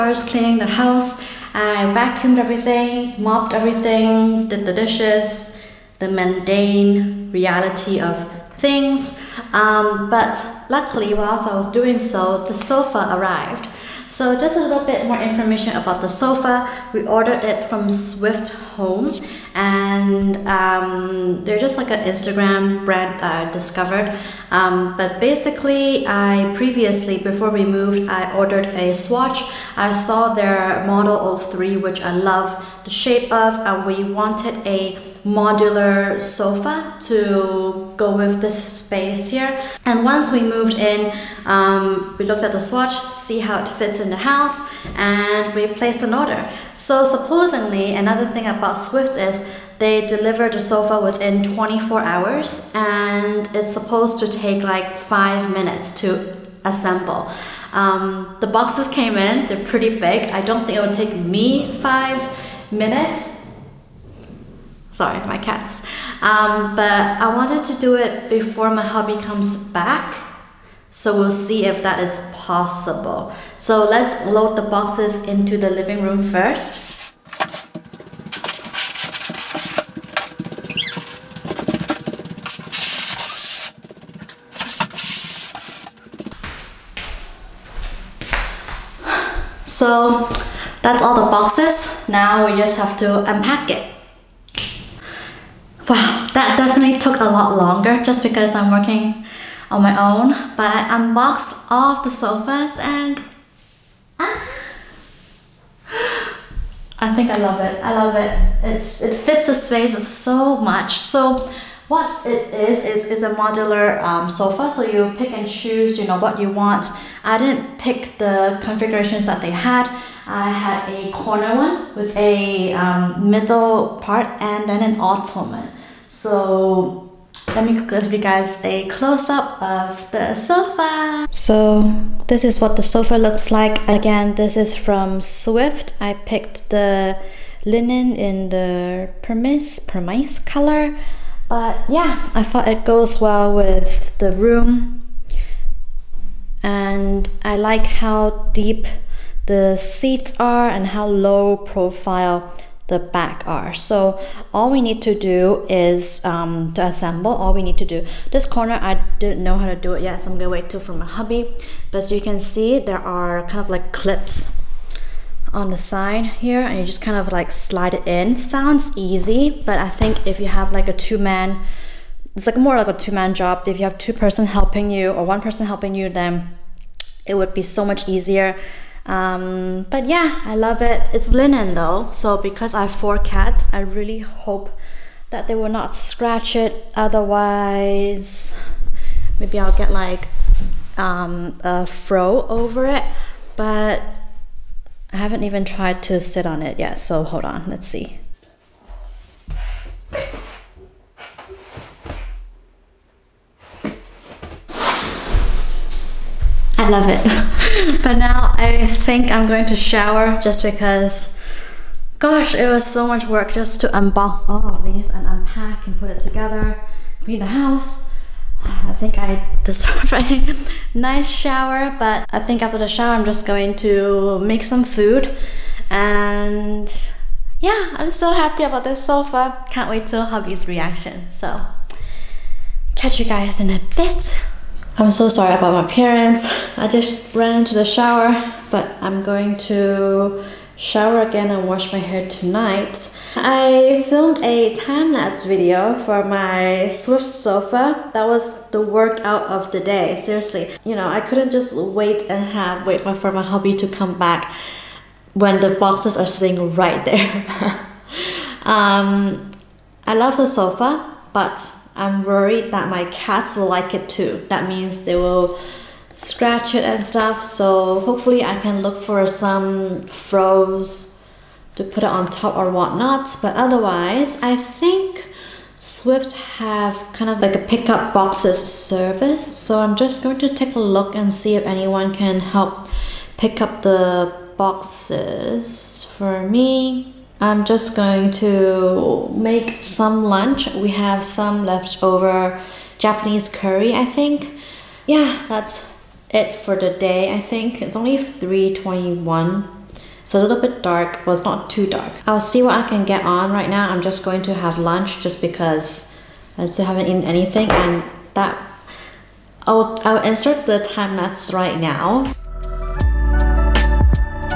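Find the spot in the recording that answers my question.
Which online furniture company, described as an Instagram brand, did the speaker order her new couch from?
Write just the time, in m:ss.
0:17.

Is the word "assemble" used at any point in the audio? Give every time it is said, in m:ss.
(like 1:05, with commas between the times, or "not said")
0:56, 2:36.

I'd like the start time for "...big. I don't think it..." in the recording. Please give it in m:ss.
1:00.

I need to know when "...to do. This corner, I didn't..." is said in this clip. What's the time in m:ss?
2:37.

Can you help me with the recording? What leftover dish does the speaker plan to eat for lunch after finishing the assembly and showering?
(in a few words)
Japanese curry.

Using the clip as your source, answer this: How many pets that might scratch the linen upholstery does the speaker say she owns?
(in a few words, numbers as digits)
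4 cats.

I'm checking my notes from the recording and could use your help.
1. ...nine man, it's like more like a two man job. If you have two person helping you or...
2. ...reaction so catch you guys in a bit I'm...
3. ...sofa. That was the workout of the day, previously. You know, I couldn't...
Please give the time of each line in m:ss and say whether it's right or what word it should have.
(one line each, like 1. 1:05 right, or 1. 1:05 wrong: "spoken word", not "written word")
1. 2:50 wrong: "two", not "nine"
2. 3:50 right
3. 4:07 wrong: "seriously", not "previously".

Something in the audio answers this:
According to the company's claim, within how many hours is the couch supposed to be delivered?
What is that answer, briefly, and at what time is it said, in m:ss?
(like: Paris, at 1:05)
24 hours, at 0:51.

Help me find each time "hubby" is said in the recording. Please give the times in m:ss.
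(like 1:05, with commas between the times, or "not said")
1:08, 2:41, 3:50.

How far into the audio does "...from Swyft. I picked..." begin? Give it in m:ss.
2:14.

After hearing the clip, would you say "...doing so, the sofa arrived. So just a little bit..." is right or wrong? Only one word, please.
right.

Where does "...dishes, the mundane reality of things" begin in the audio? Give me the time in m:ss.
0:04.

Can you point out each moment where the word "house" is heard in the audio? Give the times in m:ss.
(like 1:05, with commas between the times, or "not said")
0:00, 0:44, 3:37.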